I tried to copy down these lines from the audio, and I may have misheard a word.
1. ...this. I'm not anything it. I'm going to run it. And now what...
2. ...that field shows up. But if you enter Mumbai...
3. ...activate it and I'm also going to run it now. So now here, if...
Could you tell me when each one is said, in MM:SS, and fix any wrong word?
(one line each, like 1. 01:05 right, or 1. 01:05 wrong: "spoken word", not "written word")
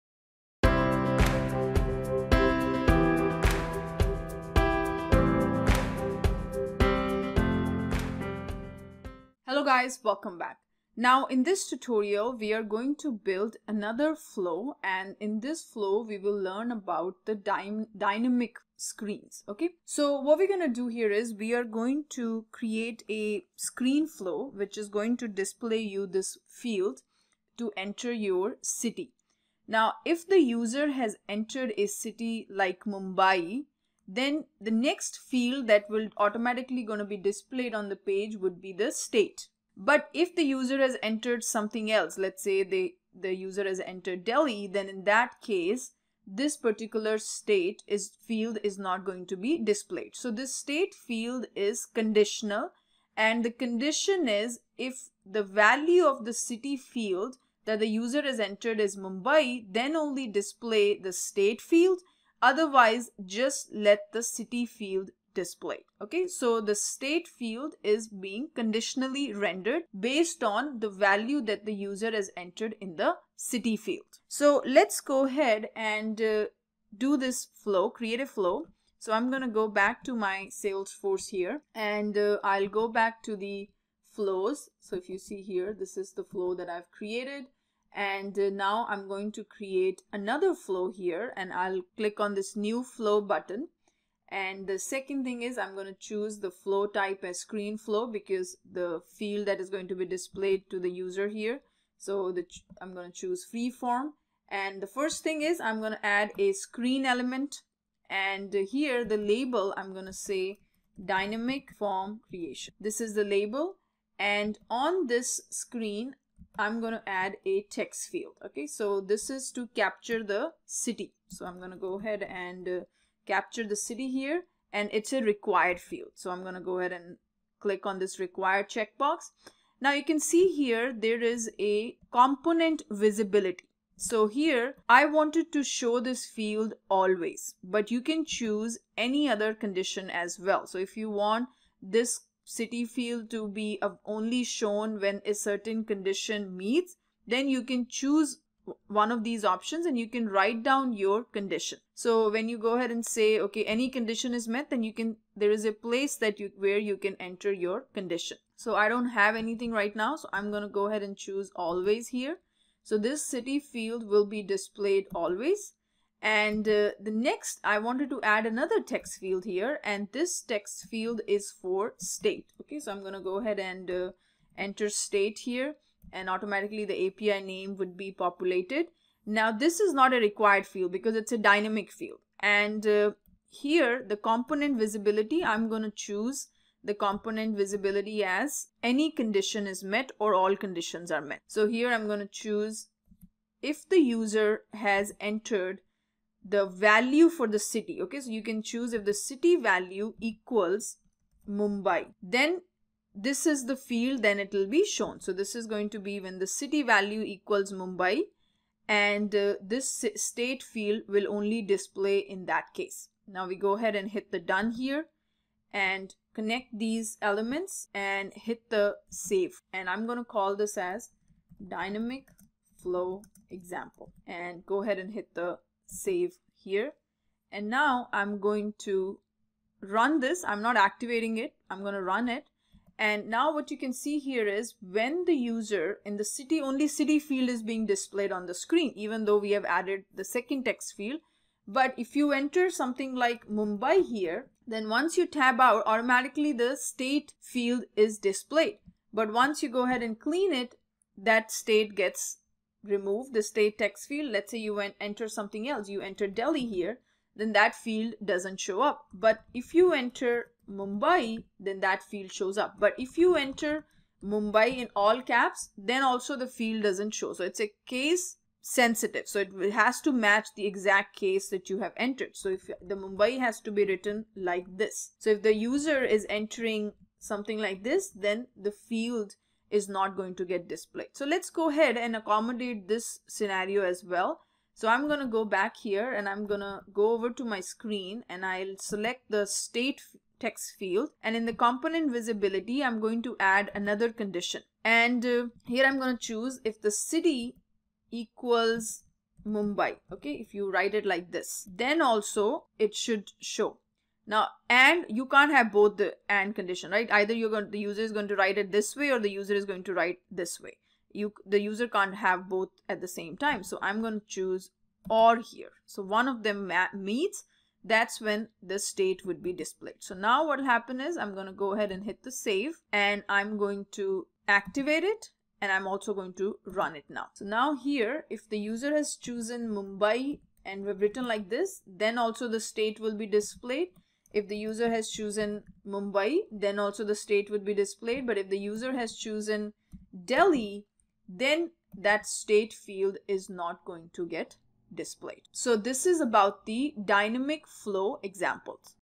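1. 03:50 wrong: "activating", not "anything"
2. 04:21 right
3. 05:24 right.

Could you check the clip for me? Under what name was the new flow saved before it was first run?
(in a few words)
Dynamic flow example.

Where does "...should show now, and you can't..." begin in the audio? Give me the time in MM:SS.
05:02.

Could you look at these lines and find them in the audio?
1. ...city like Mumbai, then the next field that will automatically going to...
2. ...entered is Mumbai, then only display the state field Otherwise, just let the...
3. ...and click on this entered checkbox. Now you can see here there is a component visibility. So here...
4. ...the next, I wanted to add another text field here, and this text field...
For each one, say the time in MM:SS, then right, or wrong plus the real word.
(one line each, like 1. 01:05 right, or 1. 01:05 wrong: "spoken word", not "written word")
1. 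00:31 right
2. 00:58 right
3. 02:06 wrong: "required", not "entered"
4. 02:46 right.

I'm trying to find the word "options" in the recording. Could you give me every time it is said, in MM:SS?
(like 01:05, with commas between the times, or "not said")
02:29.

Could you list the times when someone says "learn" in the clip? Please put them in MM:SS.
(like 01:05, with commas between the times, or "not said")
00:16.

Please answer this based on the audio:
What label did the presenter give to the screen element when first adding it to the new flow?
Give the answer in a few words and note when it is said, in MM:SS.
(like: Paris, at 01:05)
Dynamic form creation, at 01:51.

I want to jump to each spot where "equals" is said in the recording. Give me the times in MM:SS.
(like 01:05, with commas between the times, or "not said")
03:20, 03:27, 04:58.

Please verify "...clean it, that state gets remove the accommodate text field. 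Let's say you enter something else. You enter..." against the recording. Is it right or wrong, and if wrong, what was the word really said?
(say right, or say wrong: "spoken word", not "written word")
wrong: "state", not "accommodate".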